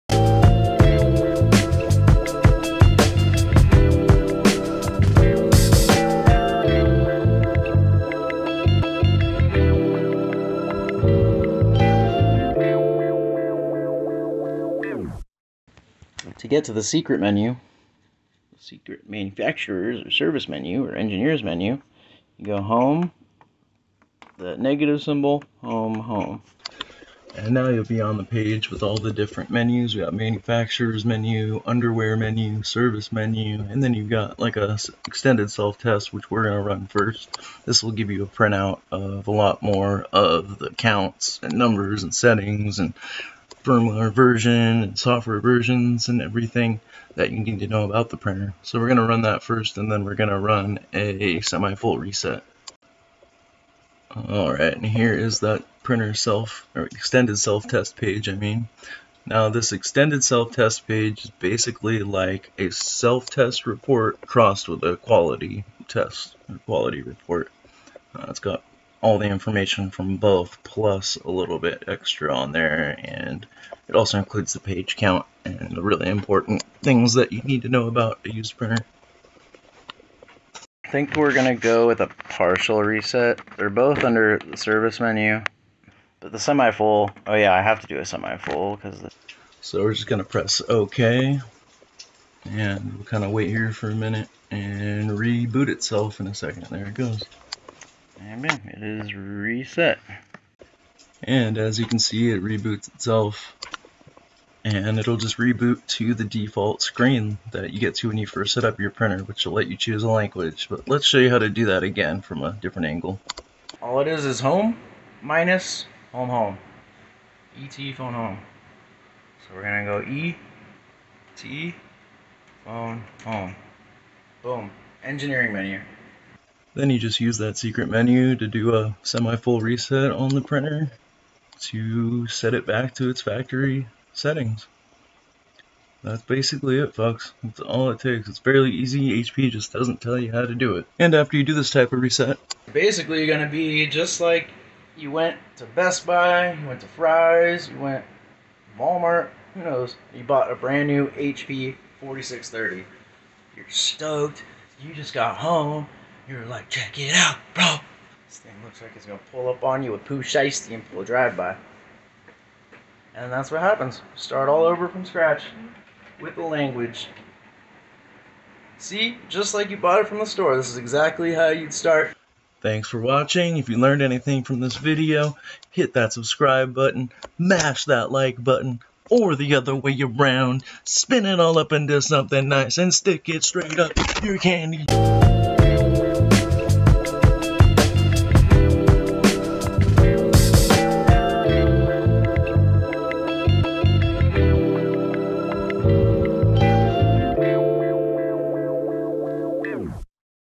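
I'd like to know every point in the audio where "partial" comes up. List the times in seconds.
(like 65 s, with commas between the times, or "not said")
82 s.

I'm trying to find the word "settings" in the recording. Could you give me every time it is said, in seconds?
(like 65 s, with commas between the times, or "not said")
42 s, 134 s.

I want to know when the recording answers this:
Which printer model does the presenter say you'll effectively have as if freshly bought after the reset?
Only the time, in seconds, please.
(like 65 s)
151 s.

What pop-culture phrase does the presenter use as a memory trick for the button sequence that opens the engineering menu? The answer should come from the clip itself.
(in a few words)
ET phone home.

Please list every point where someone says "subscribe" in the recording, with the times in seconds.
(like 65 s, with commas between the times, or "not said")
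176 s.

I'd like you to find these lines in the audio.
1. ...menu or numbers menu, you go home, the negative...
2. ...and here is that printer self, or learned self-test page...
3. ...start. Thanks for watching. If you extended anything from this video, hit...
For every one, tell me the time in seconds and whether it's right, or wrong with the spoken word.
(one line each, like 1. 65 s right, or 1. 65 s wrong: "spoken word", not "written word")
1. 20 s wrong: "engineers", not "numbers"
2. 54 s wrong: "extended", not "learned"
3. 171 s wrong: "learned", not "extended".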